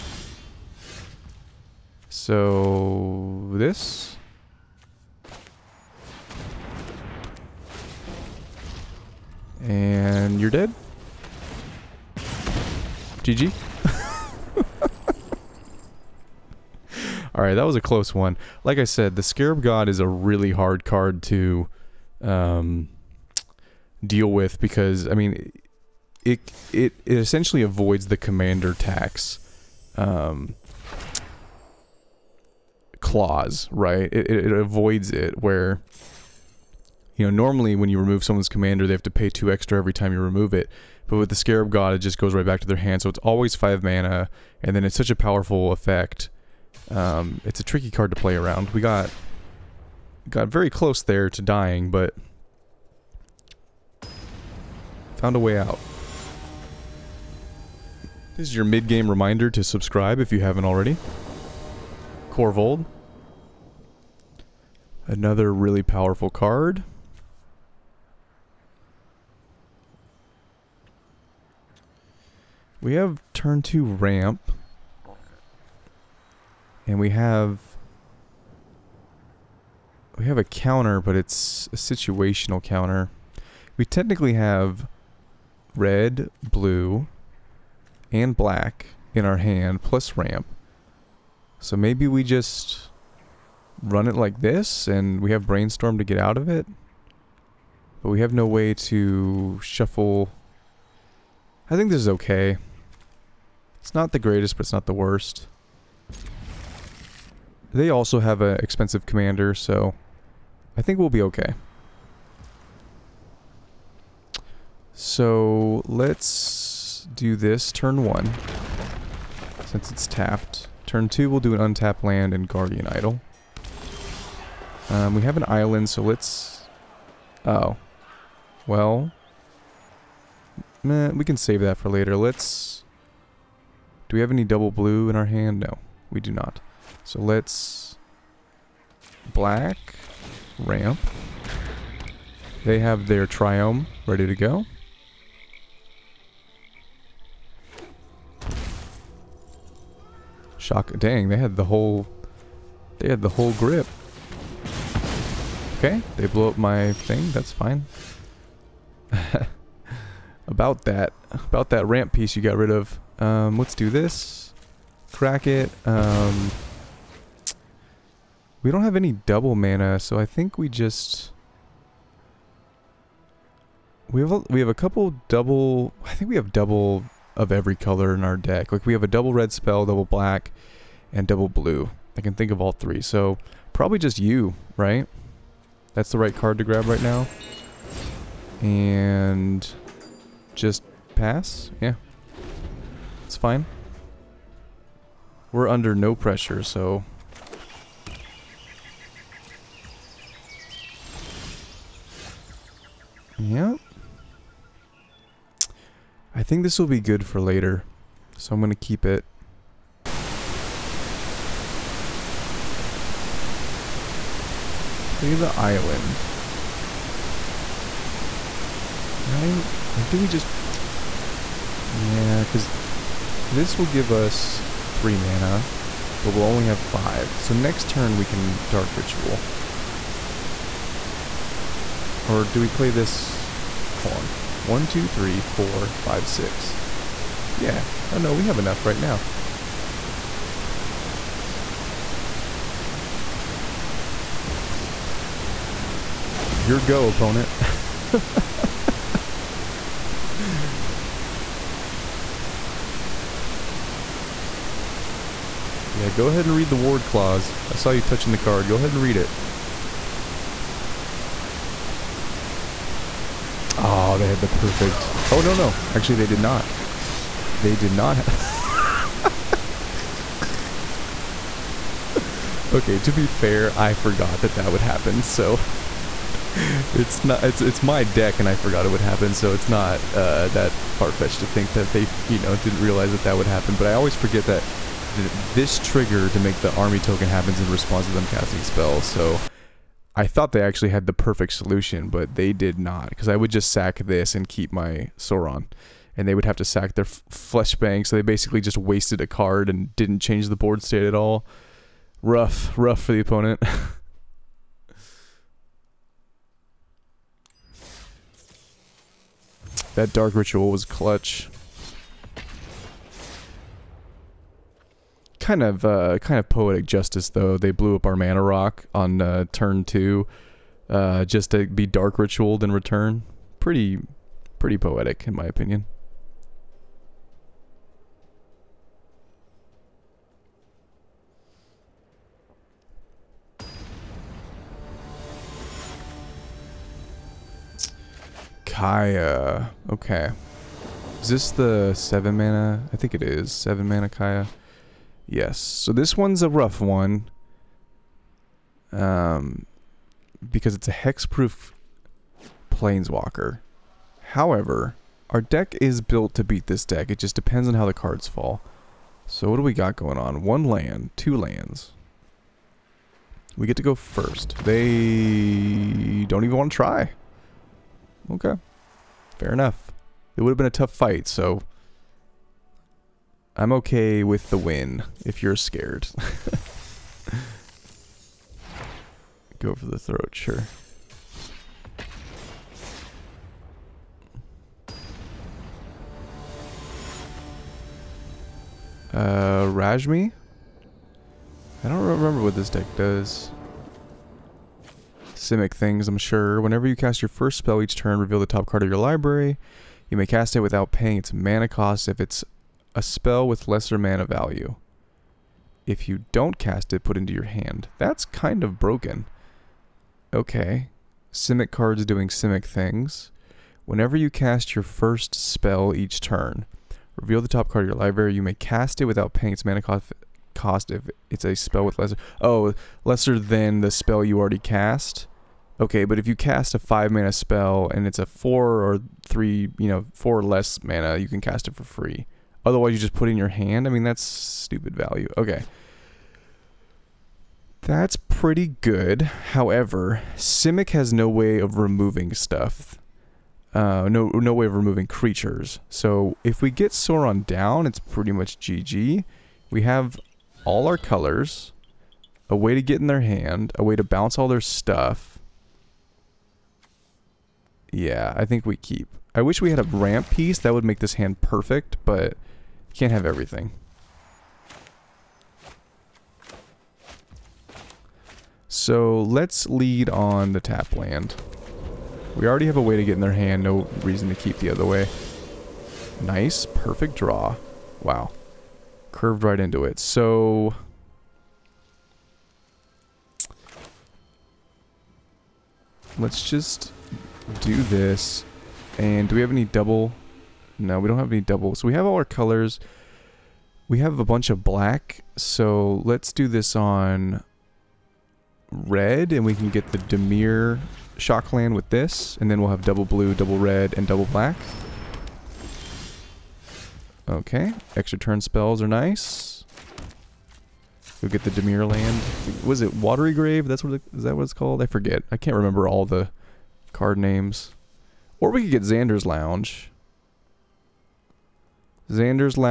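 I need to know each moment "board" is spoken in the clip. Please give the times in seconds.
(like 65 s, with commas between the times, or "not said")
300 s.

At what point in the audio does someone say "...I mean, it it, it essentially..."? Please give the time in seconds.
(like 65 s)
25 s.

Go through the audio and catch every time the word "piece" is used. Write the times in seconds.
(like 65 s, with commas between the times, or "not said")
162 s, 460 s.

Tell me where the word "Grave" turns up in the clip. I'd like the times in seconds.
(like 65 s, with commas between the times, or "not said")
513 s.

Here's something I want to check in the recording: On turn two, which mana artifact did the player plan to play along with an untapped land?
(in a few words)
Guardian Idol.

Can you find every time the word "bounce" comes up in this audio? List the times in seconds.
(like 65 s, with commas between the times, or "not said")
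454 s.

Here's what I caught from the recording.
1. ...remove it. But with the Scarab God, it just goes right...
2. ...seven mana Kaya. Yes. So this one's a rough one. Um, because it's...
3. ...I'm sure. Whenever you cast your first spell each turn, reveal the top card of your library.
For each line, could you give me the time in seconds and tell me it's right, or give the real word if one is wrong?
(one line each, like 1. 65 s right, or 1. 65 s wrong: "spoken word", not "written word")
1. 40 s right
2. 343 s right
3. 396 s right.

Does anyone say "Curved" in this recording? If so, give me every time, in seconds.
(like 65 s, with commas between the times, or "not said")
479 s.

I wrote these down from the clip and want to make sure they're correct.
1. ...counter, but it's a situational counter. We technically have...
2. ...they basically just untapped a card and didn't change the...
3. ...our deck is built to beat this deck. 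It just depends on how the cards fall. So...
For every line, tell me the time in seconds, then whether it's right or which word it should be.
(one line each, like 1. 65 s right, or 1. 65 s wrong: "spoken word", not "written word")
1. 80 s right
2. 298 s wrong: "wasted", not "untapped"
3. 355 s right.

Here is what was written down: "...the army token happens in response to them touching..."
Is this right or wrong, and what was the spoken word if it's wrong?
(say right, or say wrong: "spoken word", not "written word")
wrong: "casting", not "touching".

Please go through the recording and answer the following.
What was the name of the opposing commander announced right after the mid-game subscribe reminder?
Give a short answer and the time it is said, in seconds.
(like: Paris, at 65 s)
Korvold, at 62 s.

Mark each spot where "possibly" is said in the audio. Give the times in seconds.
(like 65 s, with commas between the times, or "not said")
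not said.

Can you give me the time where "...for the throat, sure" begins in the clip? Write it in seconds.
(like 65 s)
379 s.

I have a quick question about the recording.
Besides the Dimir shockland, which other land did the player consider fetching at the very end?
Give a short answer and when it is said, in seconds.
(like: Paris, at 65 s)
Xander's Lounge, at 518 s.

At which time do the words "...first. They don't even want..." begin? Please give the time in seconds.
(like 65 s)
363 s.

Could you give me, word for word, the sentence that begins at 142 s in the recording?
They have their triome ready to go.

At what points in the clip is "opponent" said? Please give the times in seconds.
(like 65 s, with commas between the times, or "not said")
247 s, 303 s.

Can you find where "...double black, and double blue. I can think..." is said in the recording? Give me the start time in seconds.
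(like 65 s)
179 s.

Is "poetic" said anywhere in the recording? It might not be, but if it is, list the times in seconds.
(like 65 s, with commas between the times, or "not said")
316 s, 324 s.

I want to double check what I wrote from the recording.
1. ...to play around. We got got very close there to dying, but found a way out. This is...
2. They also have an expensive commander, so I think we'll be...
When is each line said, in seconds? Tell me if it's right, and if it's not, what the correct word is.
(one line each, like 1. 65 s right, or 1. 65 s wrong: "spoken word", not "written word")
1. 48 s right
2. 107 s right.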